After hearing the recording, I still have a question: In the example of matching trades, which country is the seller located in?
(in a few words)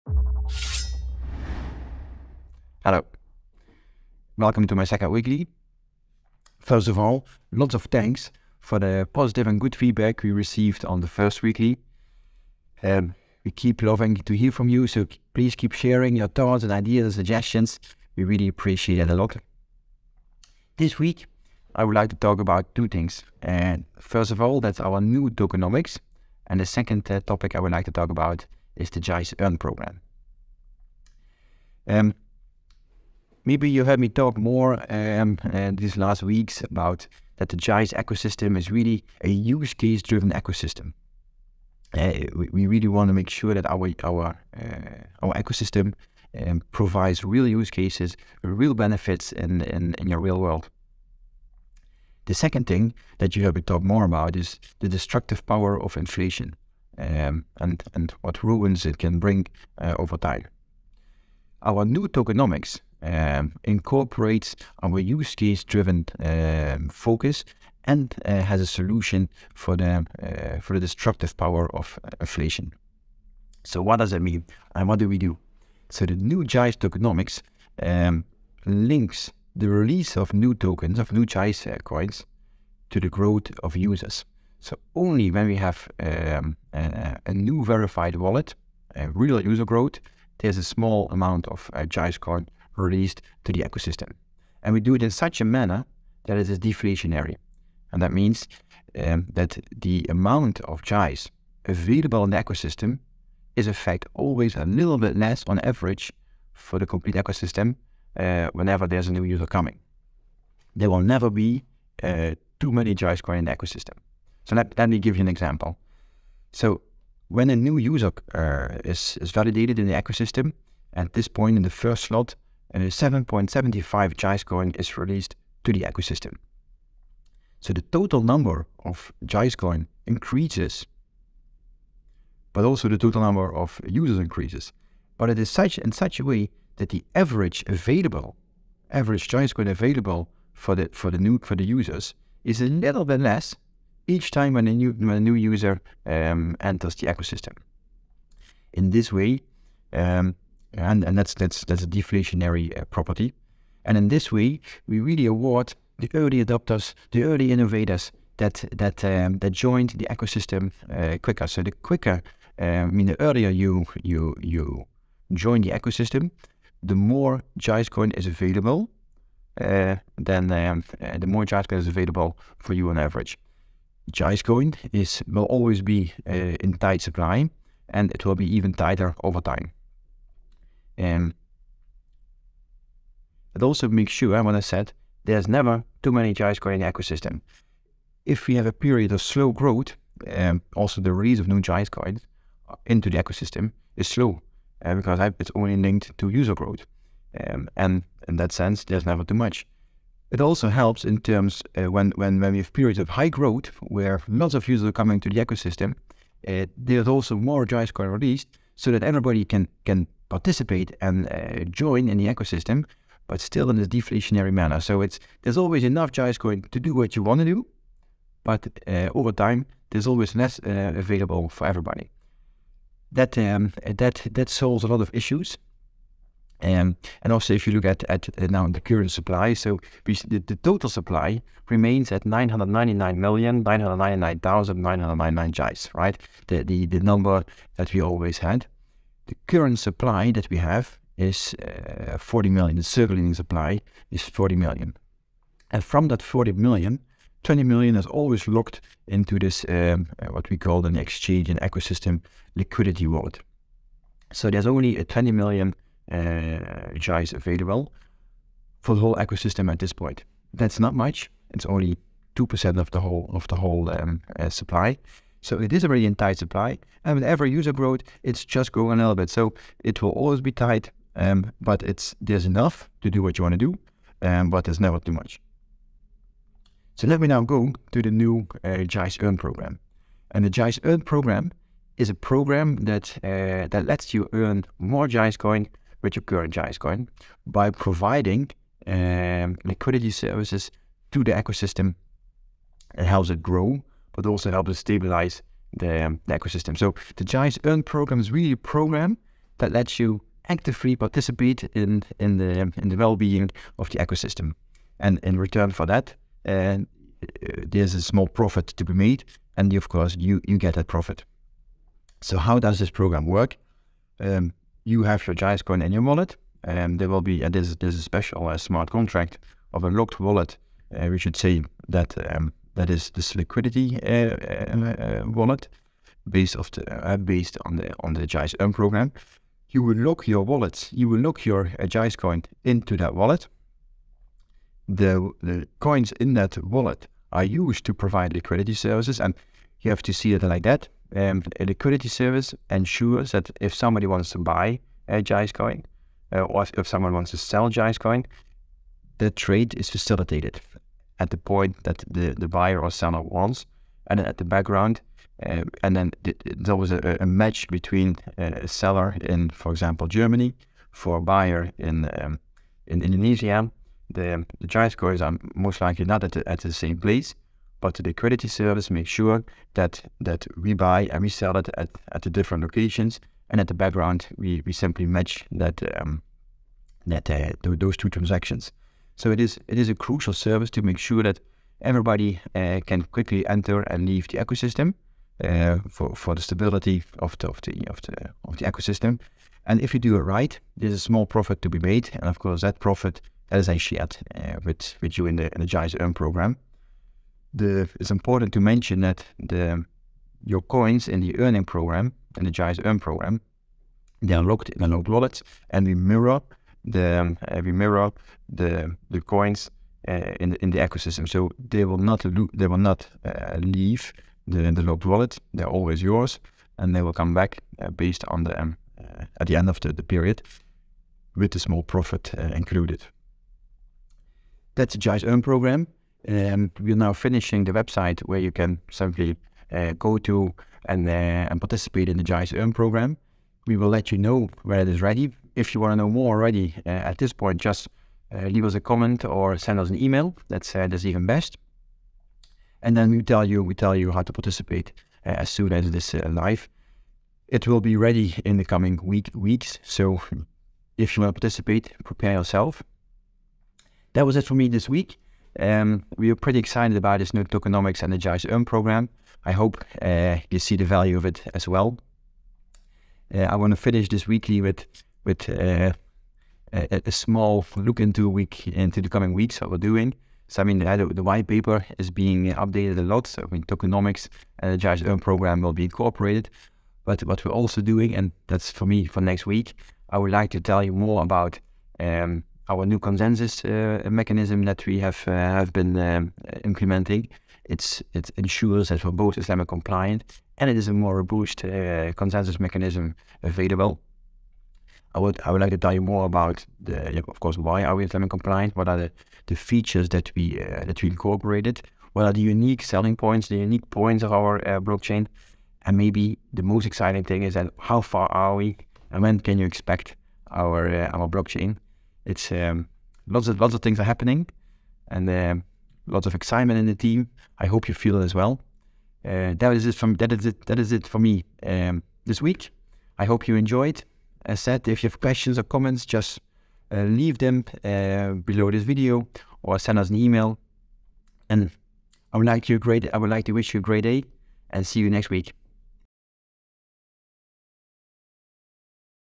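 Germany.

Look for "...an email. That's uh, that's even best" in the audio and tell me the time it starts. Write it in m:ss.
7:19.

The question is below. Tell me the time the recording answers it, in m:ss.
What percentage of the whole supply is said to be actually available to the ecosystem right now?
4:22.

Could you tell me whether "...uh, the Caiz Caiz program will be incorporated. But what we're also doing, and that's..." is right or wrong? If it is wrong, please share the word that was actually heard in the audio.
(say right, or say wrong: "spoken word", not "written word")
wrong: "Earn", not "Caiz".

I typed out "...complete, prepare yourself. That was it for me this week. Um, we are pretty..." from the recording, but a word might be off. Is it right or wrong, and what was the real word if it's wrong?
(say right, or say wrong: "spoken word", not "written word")
wrong: "participate", not "complete".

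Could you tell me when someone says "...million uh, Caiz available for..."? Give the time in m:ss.
4:15.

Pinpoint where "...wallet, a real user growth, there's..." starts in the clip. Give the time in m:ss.
1:28.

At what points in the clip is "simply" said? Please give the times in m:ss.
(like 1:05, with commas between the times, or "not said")
6:14, 7:08.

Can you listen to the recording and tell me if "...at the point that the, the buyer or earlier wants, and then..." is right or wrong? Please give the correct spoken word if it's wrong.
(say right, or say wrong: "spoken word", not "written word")
wrong: "seller", not "earlier".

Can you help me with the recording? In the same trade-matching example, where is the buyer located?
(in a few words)
Indonesia.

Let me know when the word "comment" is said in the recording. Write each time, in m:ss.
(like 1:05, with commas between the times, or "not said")
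7:18, 8:45.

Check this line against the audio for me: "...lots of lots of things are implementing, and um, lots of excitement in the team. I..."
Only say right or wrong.
wrong.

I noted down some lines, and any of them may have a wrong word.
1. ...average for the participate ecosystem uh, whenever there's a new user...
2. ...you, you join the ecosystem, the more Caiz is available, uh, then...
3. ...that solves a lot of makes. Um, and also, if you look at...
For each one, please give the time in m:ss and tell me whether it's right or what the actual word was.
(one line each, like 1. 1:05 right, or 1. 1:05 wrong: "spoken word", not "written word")
1. 1:45 wrong: "complete", not "participate"
2. 2:44 wrong: "Coin", not "Caiz"
3. 3:44 wrong: "issues", not "makes".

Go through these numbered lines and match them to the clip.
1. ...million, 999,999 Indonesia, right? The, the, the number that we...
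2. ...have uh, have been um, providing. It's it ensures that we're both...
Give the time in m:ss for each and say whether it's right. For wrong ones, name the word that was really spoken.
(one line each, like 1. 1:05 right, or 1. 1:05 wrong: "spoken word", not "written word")
1. 3:53 wrong: "Caiz", not "Indonesia"
2. 8:04 wrong: "implementing", not "providing".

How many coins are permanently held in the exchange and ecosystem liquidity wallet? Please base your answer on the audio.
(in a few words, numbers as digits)
20 million.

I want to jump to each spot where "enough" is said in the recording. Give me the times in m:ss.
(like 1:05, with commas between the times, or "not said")
3:35, 4:32.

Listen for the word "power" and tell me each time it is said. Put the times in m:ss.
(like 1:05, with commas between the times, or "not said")
0:55, 1:11.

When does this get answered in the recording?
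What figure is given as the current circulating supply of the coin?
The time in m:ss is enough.
4:02.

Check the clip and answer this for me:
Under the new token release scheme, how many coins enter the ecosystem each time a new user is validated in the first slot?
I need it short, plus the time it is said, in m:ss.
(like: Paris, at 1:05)
7.75, at 2:02.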